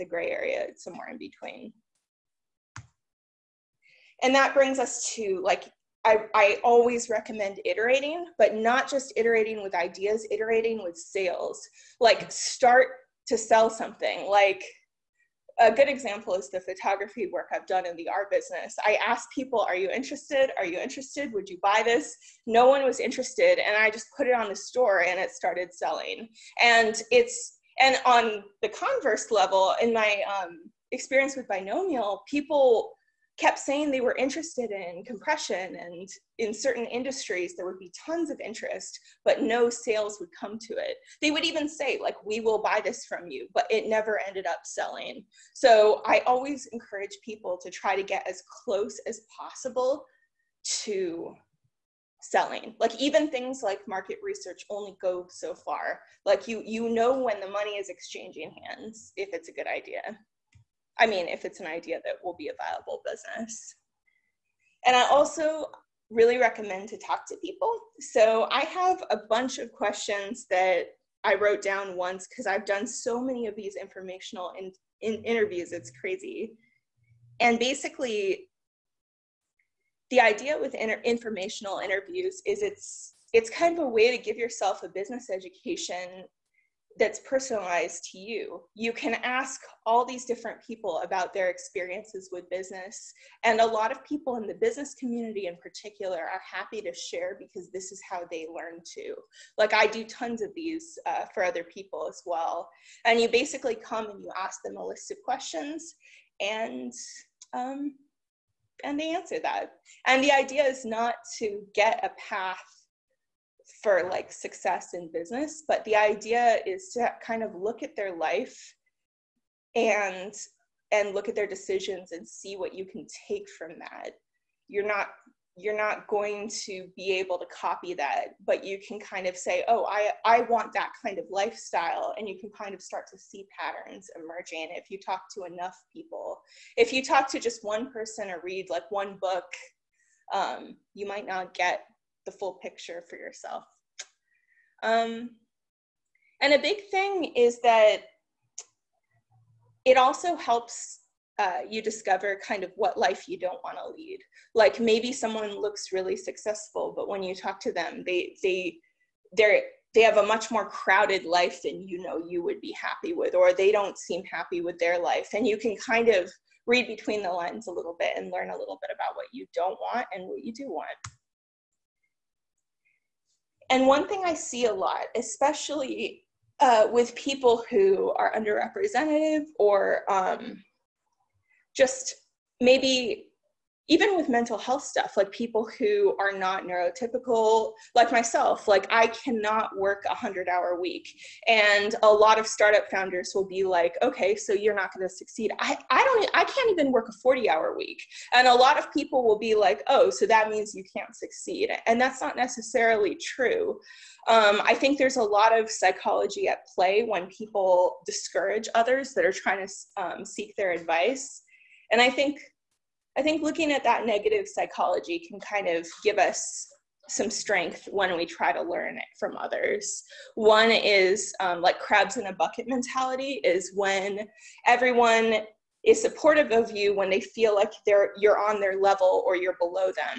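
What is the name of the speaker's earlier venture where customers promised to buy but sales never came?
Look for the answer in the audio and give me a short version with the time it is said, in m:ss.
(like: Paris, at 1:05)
Binomial, at 0:31.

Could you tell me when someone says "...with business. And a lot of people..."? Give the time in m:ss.
1:32.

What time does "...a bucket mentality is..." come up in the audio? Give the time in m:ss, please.
3:42.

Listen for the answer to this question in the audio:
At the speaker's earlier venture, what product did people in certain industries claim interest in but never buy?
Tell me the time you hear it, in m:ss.
0:35.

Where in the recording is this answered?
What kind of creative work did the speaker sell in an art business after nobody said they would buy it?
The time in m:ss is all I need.
0:16.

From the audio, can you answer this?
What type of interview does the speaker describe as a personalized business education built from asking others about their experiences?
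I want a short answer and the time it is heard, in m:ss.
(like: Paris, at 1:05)
Informational interviews, at 1:13.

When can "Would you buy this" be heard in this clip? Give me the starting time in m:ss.
0:21.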